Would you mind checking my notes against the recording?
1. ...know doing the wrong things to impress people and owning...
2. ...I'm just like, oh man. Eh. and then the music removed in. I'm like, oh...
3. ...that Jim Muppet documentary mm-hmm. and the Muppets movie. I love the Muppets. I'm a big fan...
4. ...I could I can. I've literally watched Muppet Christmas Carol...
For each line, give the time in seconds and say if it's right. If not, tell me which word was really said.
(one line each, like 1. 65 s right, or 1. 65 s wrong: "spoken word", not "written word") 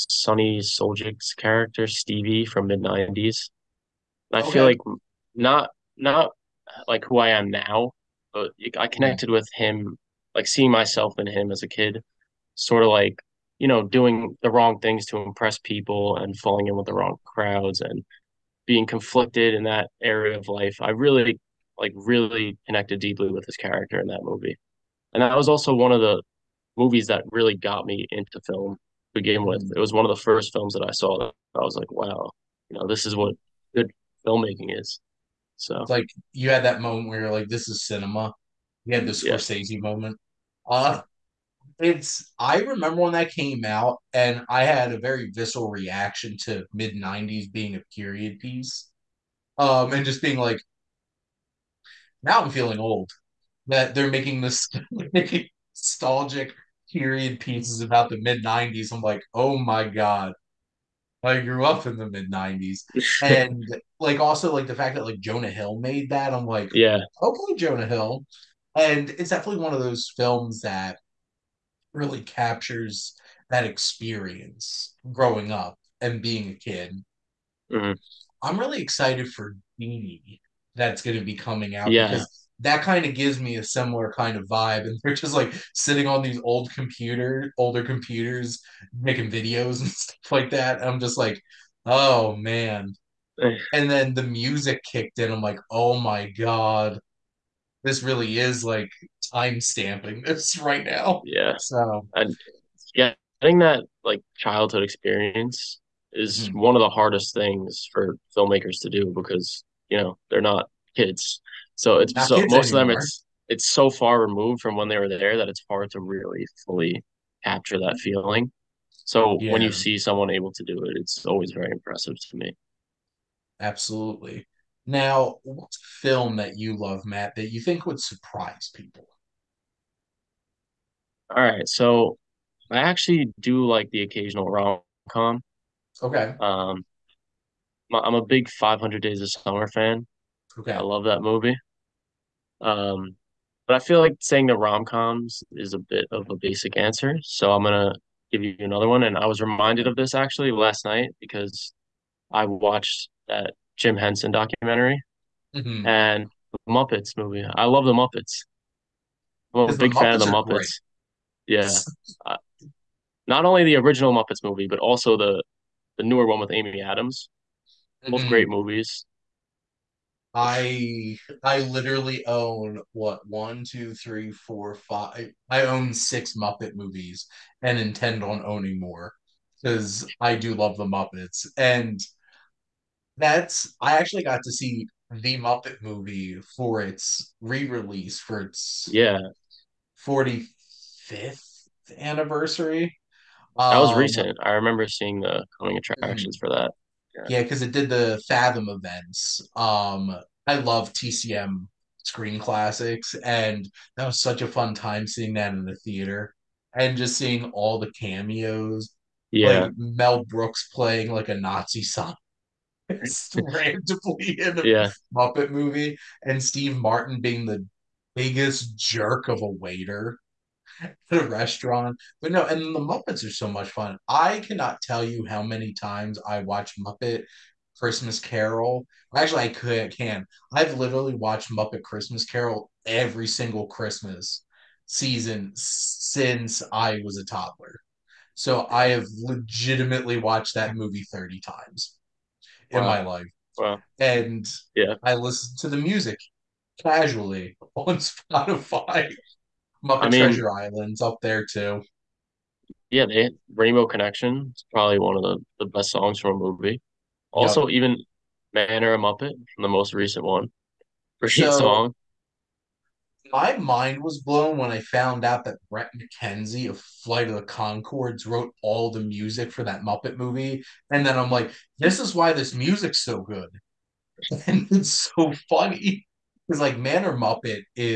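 1. 13 s wrong: "falling", not "owning"
2. 90 s wrong: "kicked", not "removed"
3. 153 s wrong: "Henson", not "Muppet"
4. 229 s right.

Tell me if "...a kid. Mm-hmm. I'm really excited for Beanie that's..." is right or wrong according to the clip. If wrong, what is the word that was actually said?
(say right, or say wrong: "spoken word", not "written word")
right.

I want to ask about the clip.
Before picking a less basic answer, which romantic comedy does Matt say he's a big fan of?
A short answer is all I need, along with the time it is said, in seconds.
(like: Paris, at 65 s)
500 Days of Summer, at 138 s.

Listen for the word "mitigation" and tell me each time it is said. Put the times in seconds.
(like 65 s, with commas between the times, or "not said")
not said.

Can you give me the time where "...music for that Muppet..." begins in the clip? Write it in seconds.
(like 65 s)
269 s.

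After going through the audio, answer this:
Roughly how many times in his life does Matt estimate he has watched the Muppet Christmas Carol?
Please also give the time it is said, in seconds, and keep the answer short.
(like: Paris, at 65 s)
30, at 241 s.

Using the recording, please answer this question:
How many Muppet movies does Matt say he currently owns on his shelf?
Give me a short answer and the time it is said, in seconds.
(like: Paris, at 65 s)
6, at 175 s.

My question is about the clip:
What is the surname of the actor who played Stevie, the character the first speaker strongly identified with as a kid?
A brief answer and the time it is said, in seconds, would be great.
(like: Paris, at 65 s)
Suljic, at 0 s.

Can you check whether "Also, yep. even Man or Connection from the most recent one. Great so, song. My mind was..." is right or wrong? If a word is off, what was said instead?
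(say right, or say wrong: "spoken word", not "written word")
wrong: "Muppet", not "Connection".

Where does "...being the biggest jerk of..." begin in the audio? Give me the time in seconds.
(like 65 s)
217 s.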